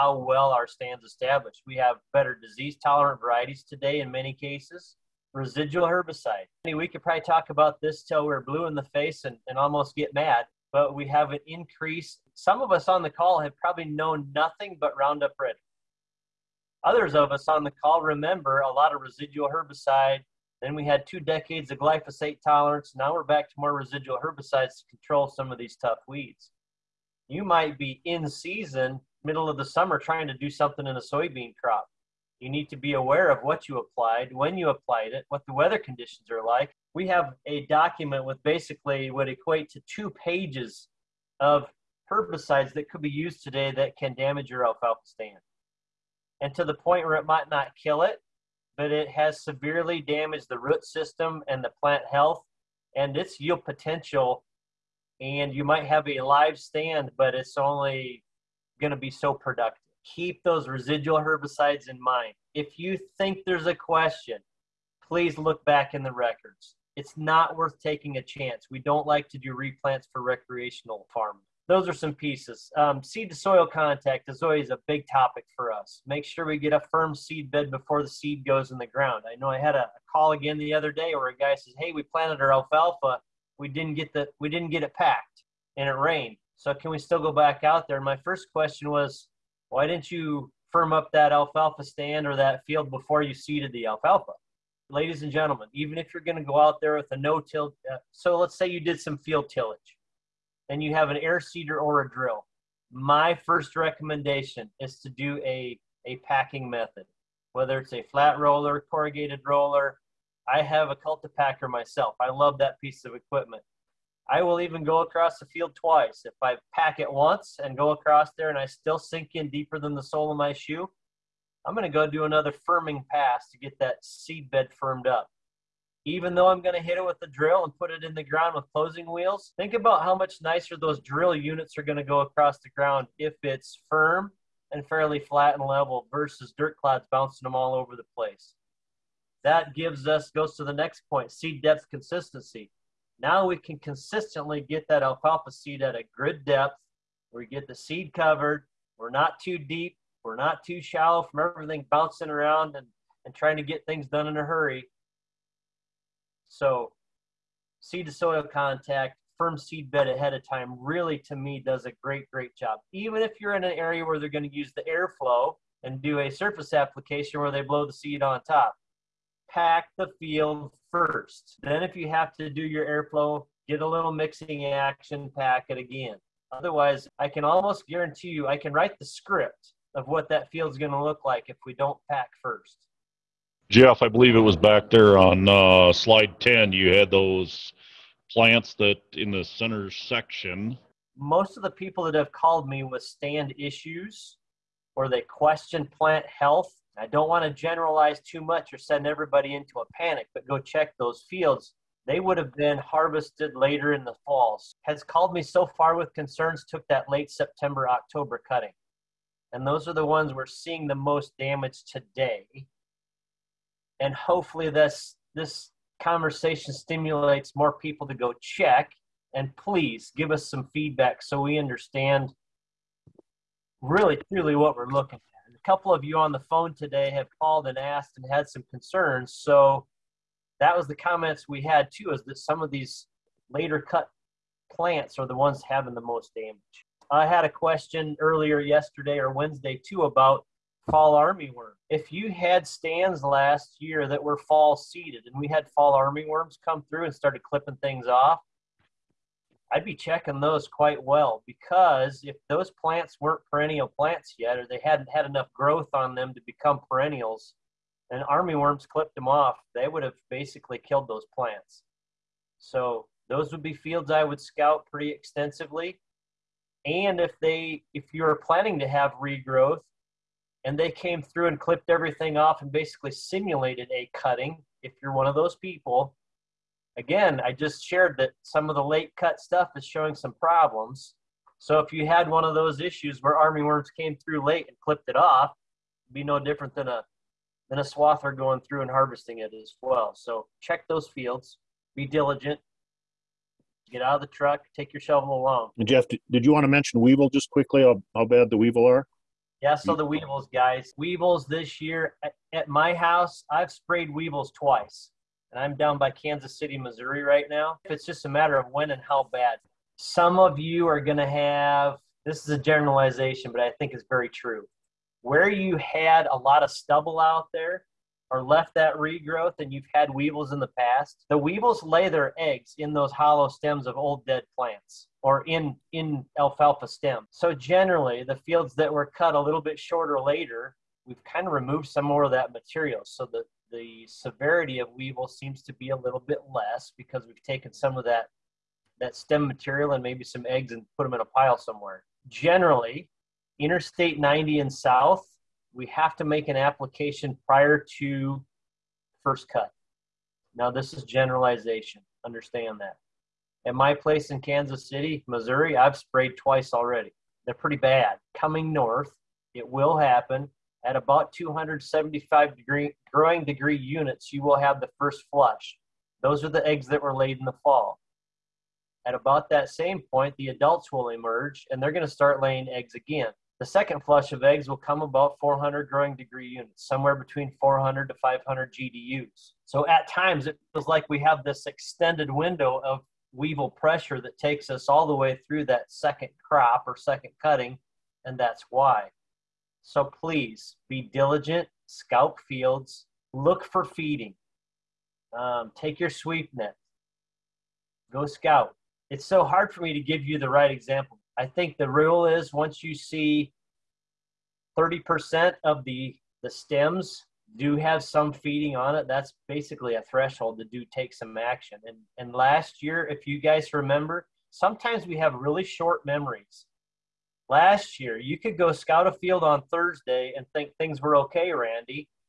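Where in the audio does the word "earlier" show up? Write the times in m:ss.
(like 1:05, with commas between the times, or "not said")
3:58.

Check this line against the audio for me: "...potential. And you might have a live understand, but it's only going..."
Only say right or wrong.
wrong.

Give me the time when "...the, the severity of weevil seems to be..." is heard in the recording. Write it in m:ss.
5:33.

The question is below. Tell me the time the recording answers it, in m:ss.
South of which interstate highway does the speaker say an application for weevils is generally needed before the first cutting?
5:43.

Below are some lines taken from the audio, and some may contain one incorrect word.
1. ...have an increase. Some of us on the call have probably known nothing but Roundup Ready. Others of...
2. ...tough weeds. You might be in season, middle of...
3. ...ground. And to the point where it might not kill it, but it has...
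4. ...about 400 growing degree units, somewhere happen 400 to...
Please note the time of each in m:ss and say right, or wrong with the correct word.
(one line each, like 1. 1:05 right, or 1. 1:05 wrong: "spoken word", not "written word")
1. 0:11 right
2. 0:25 right
3. 0:45 wrong: "stand", not "ground"
4. 6:14 wrong: "between", not "happen".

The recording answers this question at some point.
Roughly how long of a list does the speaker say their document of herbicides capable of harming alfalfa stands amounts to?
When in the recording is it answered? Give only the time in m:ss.
0:39.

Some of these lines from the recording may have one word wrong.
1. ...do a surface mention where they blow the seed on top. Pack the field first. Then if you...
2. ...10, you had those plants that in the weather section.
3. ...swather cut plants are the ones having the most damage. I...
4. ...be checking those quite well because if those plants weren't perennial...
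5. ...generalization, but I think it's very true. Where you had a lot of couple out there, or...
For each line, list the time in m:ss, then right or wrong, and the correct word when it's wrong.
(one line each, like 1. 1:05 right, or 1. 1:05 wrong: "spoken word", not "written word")
1. 2:46 wrong: "application", not "mention"
2. 3:06 wrong: "center", not "weather"
3. 3:53 wrong: "later", not "swather"
4. 4:09 right
5. 5:12 wrong: "stubble", not "couple".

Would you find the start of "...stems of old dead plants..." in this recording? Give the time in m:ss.
5:23.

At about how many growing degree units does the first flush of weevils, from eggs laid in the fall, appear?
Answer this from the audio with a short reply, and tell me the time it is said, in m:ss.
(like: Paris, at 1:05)
275, at 6:01.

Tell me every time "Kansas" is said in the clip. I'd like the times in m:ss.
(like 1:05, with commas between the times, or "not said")
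5:06, 5:54.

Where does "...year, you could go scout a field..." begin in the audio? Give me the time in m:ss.
6:57.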